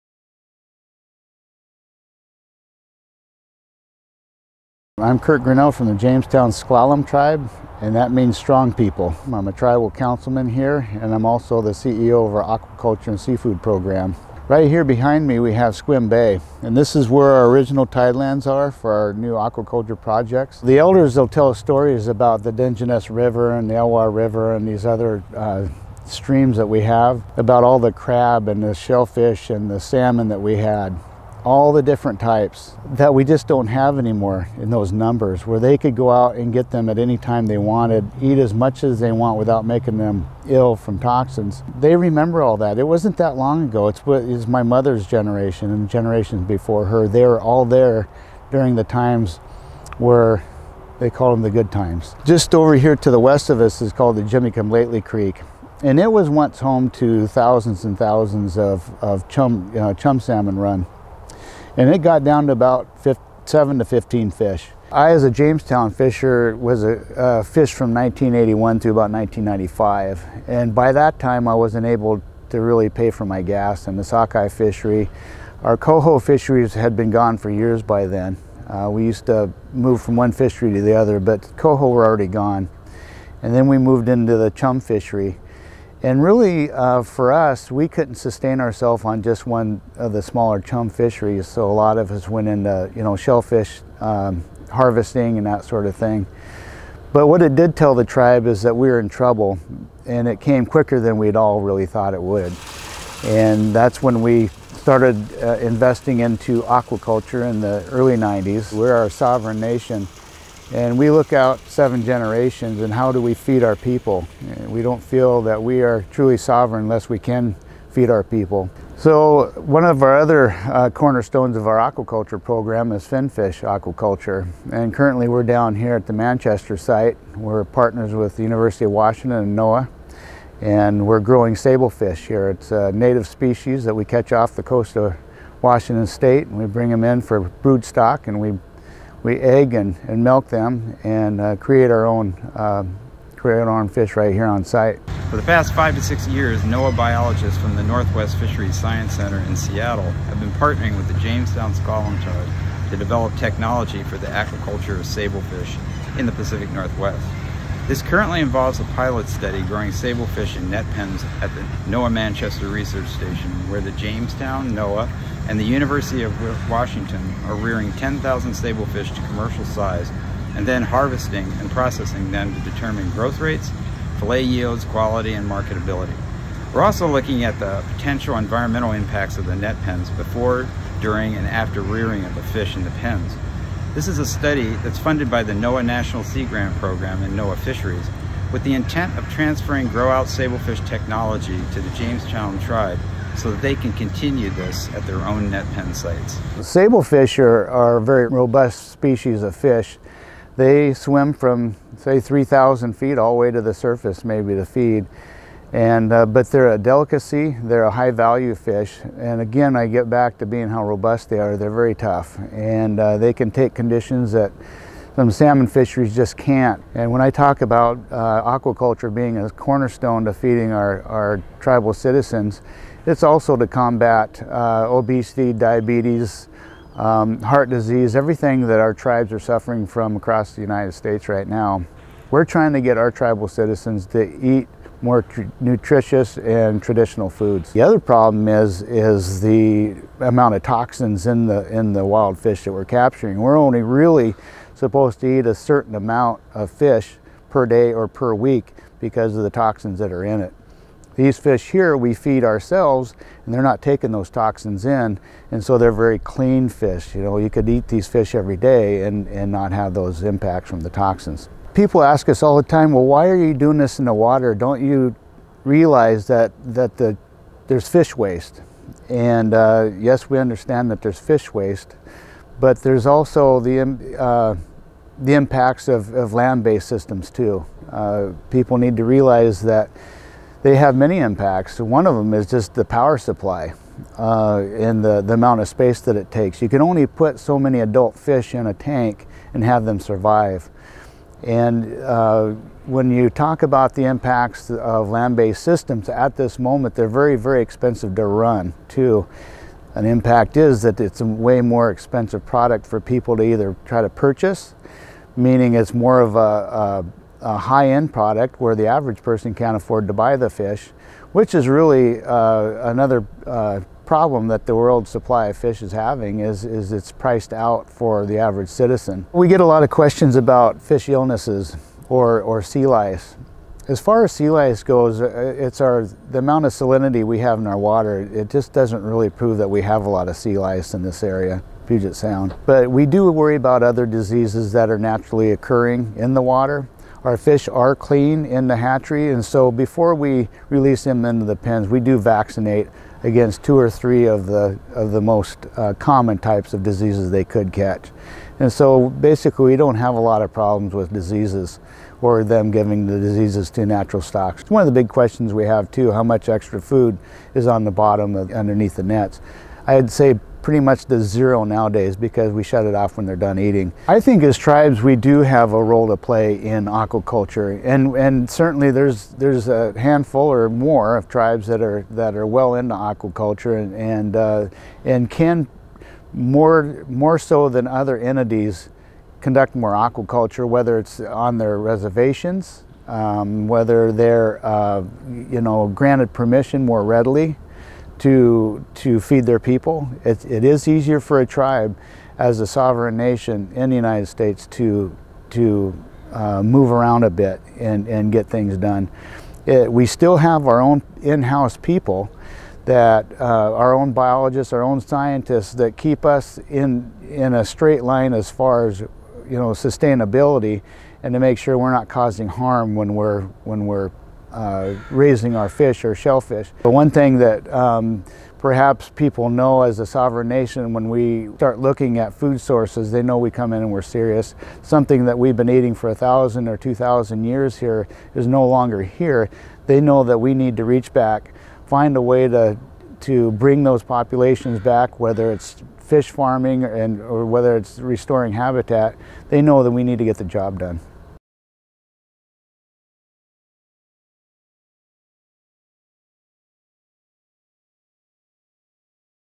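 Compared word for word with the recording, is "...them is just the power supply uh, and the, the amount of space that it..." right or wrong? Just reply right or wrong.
right.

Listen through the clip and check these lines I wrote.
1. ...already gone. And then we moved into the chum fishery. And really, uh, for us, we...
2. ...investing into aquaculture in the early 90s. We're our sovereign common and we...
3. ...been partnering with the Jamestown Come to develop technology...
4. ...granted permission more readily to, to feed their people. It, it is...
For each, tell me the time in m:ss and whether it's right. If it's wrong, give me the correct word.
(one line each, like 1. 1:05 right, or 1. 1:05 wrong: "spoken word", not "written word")
1. 1:22 right
2. 1:45 wrong: "nation", not "common"
3. 2:30 wrong: "Scotland", not "Come"
4. 6:25 right.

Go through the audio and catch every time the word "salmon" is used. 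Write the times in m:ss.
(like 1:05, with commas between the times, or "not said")
0:29, 1:00, 3:35.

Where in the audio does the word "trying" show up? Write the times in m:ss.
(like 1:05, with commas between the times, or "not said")
3:52.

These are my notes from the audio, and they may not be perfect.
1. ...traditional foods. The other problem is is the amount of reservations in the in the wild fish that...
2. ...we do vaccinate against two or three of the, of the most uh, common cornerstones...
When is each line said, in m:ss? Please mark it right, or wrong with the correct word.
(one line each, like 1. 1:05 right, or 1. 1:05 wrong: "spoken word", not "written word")
1. 3:56 wrong: "toxins", not "reservations"
2. 5:41 wrong: "types", not "cornerstones".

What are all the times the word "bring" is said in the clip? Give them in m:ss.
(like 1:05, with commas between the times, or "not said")
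2:16, 7:13.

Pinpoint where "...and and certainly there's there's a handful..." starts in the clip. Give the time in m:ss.
6:07.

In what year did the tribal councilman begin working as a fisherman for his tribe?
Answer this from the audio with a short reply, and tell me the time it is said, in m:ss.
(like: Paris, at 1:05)
1981, at 1:07.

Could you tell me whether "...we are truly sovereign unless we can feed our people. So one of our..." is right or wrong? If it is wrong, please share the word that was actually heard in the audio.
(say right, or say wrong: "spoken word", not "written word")
right.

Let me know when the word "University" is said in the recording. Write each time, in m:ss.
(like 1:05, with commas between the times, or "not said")
2:08, 2:45.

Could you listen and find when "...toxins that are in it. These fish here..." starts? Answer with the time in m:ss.
4:09.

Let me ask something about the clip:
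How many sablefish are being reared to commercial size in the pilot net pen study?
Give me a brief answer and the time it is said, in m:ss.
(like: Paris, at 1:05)
10,000, at 2:47.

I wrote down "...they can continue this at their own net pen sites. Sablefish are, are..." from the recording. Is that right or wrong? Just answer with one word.
right.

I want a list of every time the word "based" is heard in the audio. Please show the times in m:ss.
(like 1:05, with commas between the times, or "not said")
4:36, 4:55.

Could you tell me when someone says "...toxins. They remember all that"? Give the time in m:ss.
0:40.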